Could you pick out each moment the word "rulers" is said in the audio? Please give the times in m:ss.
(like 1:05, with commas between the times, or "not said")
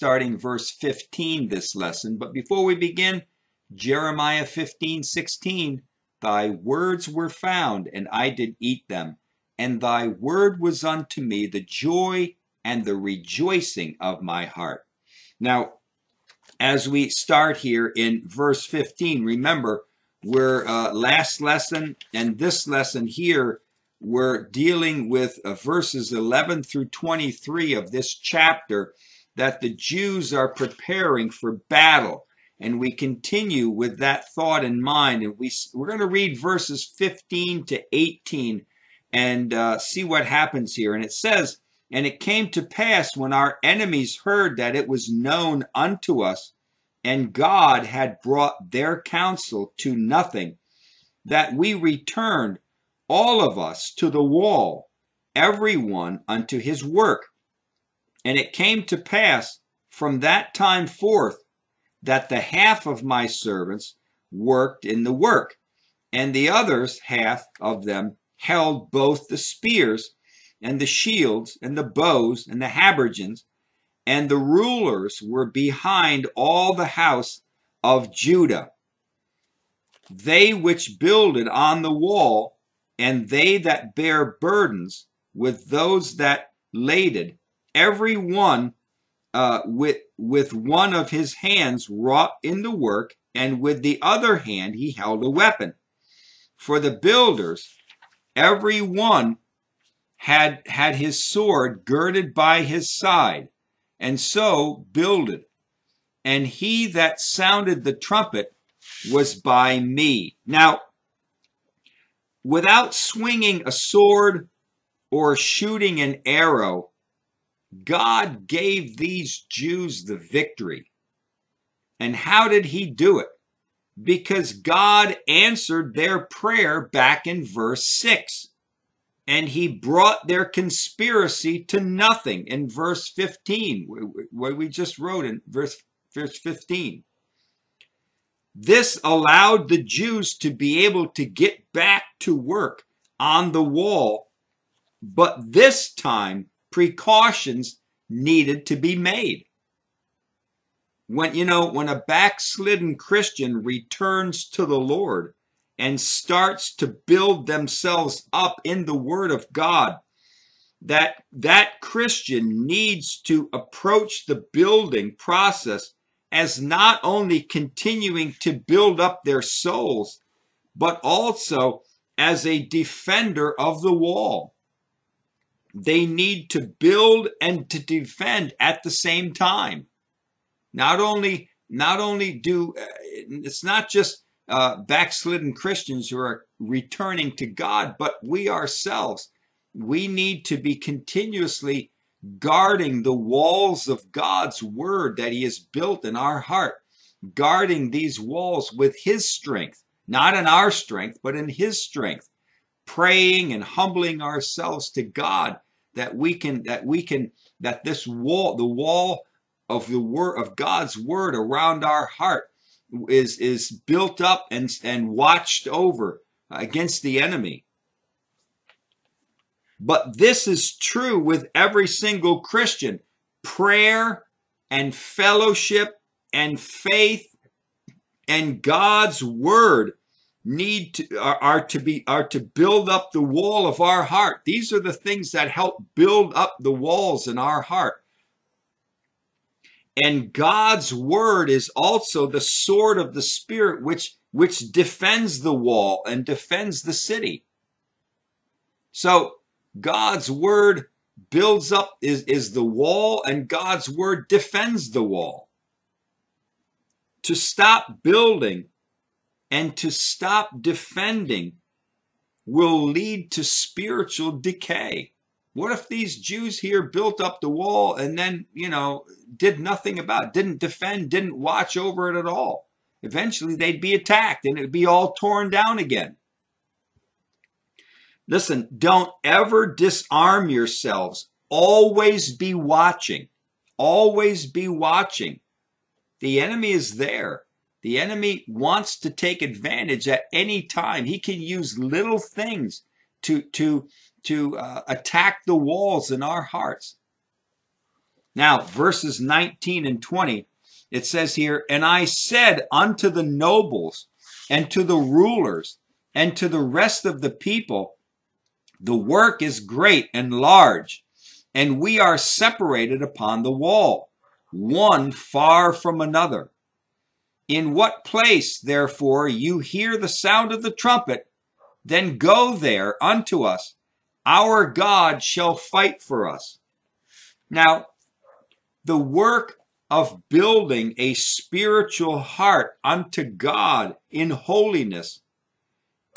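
1:14, 5:04.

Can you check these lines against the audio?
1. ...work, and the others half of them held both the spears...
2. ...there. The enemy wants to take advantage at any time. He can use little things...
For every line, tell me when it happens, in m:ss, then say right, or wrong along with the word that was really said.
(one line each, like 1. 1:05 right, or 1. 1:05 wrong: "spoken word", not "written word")
1. 1:05 right
2. 4:46 right.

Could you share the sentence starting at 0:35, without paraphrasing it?
And we, we're going to read verses 15 to 18 and uh, see what happens here.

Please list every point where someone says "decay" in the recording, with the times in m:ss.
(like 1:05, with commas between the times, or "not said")
4:24.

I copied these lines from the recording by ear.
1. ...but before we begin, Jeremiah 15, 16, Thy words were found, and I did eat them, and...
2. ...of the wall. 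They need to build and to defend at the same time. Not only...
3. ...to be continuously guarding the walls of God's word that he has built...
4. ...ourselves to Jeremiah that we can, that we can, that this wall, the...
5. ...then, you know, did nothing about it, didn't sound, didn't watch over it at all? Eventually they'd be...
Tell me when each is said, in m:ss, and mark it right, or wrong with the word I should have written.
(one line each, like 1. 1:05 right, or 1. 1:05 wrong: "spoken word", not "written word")
1. 0:02 right
2. 2:53 right
3. 3:10 right
4. 3:24 wrong: "God", not "Jeremiah"
5. 4:28 wrong: "defend", not "sound".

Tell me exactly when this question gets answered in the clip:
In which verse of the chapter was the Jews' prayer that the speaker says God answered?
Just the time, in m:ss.
2:07.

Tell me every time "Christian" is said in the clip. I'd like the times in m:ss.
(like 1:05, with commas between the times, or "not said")
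2:32, 2:41, 3:05, 3:42.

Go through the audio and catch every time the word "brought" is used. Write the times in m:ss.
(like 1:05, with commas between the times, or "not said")
0:48, 2:09.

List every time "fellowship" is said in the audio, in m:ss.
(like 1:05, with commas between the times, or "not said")
3:44.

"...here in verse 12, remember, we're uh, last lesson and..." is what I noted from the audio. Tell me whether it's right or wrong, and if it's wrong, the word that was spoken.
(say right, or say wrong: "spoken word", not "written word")
wrong: "15", not "12".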